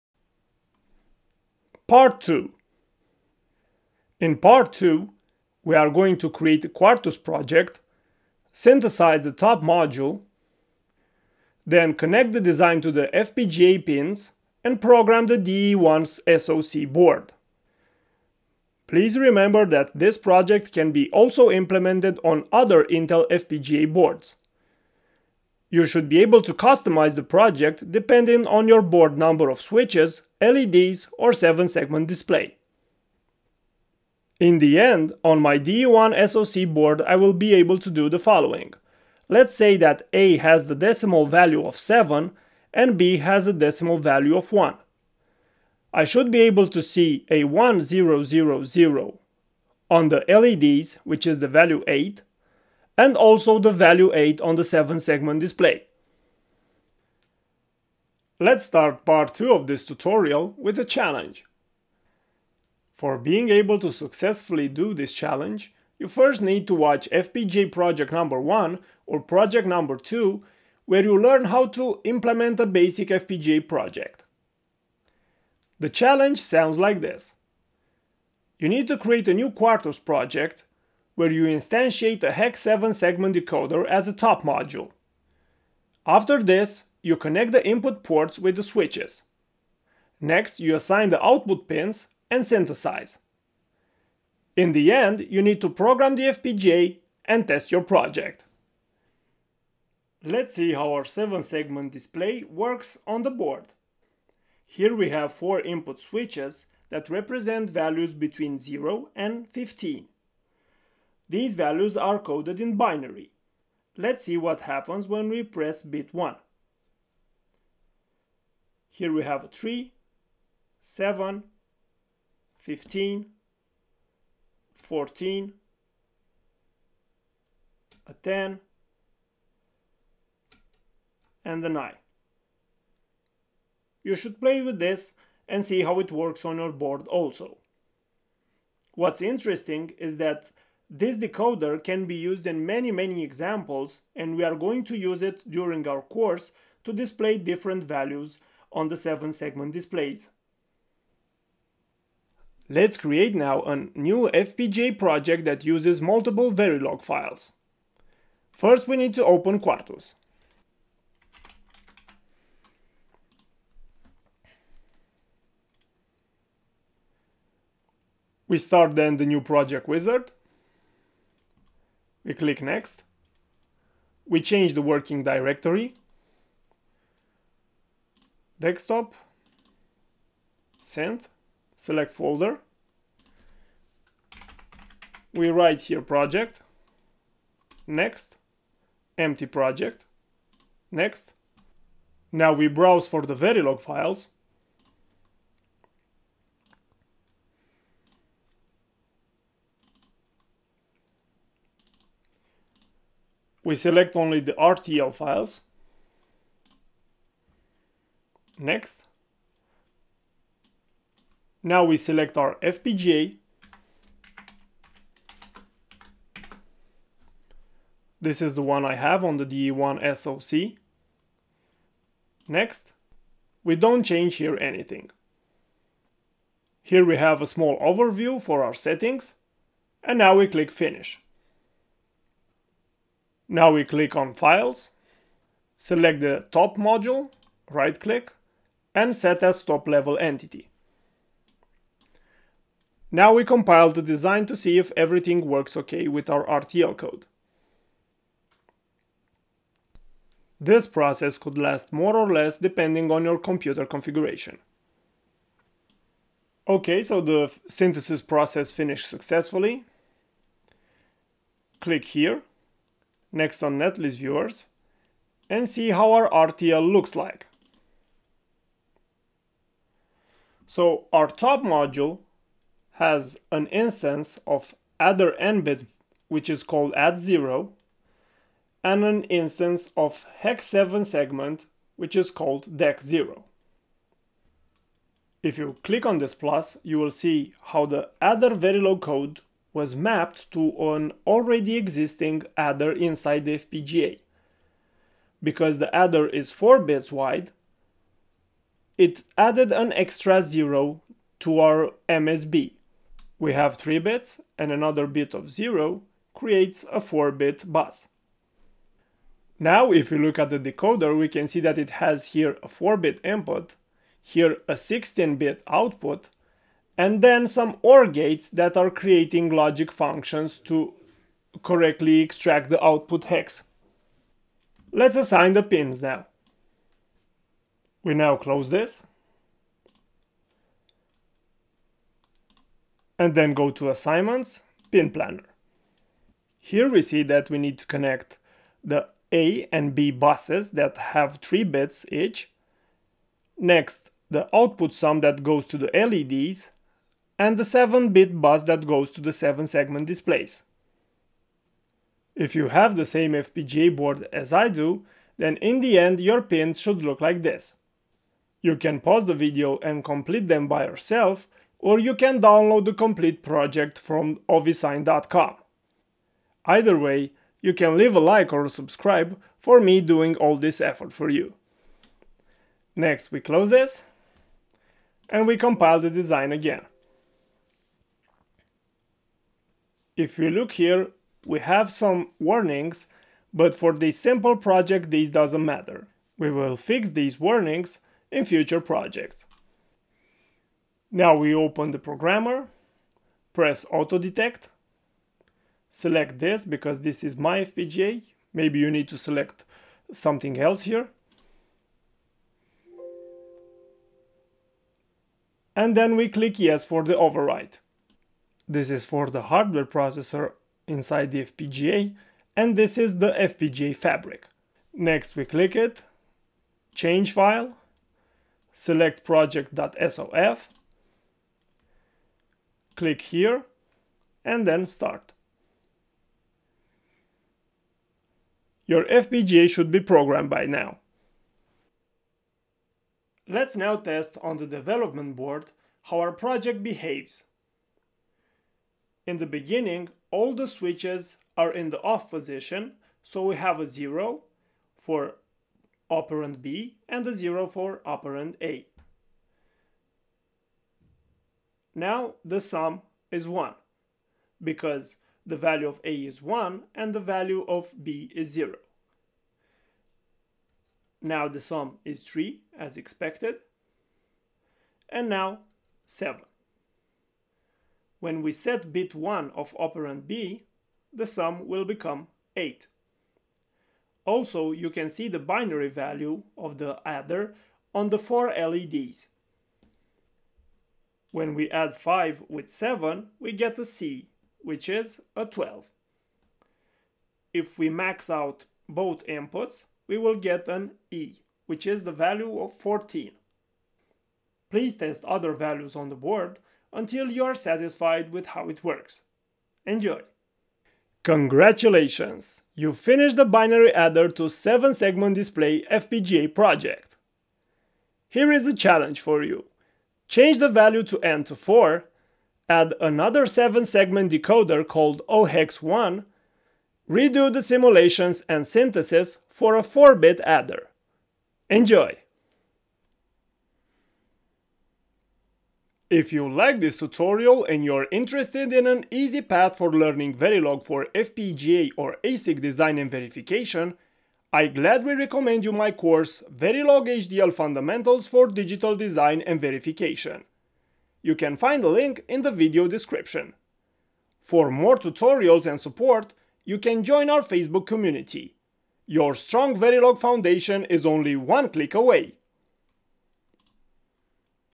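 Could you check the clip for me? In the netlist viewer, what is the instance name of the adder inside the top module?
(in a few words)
add0.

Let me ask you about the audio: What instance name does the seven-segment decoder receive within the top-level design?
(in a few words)
dec0.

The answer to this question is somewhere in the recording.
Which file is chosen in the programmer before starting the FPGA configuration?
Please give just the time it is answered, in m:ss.
6:59.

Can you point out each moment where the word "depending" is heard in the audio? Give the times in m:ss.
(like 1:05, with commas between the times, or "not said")
0:27, 4:12.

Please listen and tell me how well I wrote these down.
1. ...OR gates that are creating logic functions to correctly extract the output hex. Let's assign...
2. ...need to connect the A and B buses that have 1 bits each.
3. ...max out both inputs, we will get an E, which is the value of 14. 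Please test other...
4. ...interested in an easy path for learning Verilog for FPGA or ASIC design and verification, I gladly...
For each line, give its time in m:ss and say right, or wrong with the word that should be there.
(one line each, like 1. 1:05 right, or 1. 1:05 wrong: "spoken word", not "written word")
1. 5:17 right
2. 5:37 wrong: "3", not "1"
3. 8:07 right
4. 8:48 right.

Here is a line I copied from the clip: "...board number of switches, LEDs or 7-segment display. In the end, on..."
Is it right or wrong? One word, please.
right.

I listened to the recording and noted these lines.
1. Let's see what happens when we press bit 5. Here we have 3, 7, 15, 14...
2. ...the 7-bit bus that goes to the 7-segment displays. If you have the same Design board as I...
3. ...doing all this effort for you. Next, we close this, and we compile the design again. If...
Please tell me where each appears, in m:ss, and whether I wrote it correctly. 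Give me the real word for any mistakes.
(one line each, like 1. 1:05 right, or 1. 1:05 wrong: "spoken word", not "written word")
1. 1:53 wrong: "1", not "5"
2. 5:47 wrong: "FPGA", not "Design"
3. 6:09 right.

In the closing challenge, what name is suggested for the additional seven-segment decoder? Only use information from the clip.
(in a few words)
OHEX1.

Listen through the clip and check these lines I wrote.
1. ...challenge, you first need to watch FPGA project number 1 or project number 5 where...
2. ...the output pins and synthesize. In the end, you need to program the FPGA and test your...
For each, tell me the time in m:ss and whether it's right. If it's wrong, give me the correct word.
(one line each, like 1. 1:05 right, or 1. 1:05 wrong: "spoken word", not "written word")
1. 1:05 wrong: "2", not "5"
2. 1:31 right.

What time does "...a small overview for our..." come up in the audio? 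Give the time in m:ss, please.
3:47.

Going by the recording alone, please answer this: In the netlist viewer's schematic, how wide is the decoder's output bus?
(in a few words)
16 bits.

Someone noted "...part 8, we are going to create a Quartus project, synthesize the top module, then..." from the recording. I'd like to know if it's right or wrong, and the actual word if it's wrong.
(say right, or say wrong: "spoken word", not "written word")
wrong: "2", not "8".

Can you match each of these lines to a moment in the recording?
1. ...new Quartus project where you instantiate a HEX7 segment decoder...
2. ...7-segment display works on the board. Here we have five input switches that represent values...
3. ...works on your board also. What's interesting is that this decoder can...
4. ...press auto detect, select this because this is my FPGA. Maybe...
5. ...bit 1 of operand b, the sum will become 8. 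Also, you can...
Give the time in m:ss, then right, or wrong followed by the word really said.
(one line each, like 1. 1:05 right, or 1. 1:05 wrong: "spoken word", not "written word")
1. 1:19 right
2. 1:41 wrong: "four", not "five"
3. 2:16 right
4. 6:33 right
5. 7:48 right.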